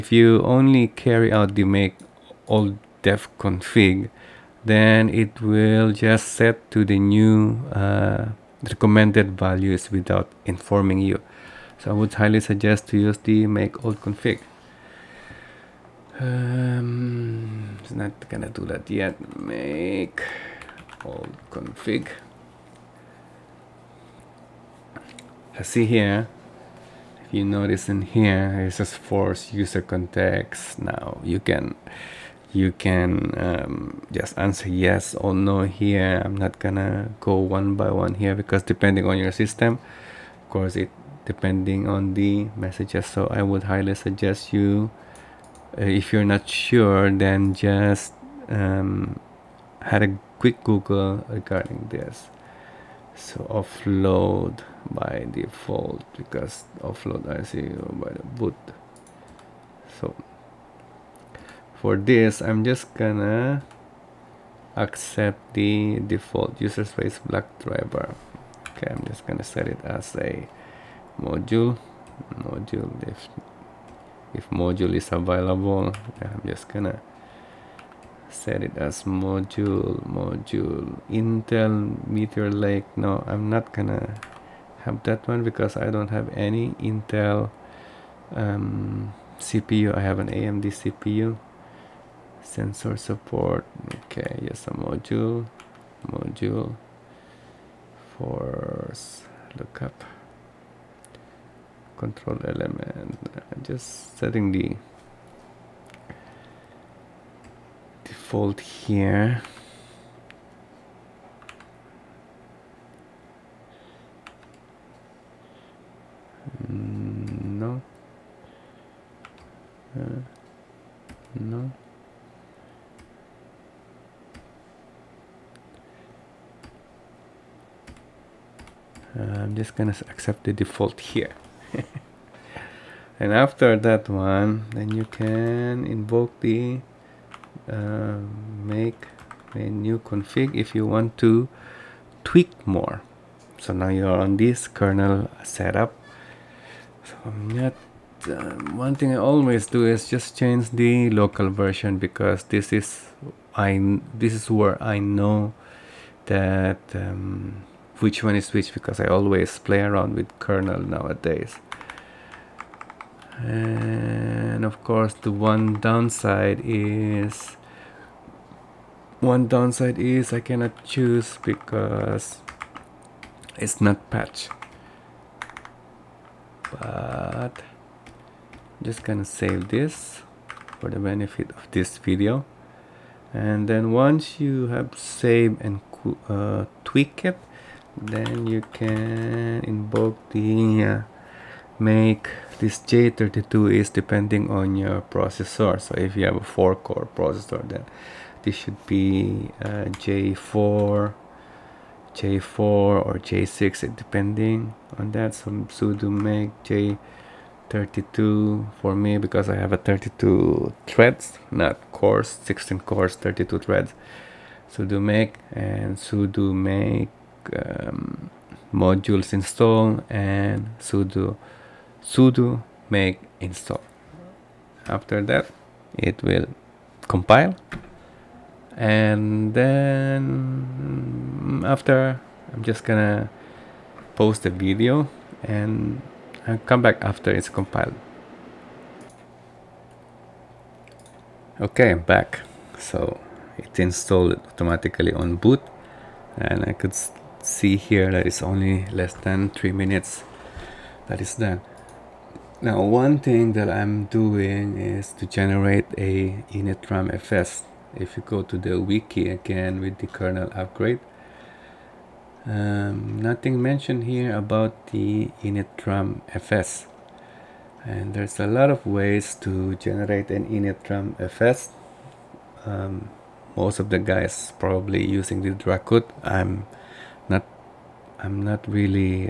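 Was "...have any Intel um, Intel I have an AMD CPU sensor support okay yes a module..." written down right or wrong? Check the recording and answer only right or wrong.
wrong.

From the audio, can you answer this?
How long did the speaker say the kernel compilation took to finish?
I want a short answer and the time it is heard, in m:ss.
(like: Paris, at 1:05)
less than three minutes, at 4:08.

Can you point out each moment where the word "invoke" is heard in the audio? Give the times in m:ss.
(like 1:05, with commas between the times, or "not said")
2:15, 3:09.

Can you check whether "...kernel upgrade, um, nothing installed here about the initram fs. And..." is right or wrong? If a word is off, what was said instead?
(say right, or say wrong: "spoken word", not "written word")
wrong: "mentioned", not "installed".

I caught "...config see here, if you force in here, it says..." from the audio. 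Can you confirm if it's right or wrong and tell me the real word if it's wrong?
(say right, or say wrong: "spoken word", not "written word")
wrong: "notice", not "force".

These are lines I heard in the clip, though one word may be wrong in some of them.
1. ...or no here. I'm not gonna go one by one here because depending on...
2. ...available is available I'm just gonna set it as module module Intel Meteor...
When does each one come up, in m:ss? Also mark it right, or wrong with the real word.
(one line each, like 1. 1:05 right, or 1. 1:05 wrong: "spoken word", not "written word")
1. 0:35 right
2. 1:14 wrong: "module", not "available".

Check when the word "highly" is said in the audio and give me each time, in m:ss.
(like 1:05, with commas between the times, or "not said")
0:12, 0:43.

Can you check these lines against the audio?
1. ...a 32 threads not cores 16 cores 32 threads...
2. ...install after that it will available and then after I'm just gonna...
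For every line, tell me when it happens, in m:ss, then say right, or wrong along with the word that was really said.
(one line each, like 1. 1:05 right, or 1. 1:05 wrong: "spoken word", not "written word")
1. 3:29 right
2. 3:43 wrong: "compile", not "available".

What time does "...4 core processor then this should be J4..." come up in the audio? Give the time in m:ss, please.
3:16.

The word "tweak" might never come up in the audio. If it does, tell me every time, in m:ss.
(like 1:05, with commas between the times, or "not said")
2:22, 3:06.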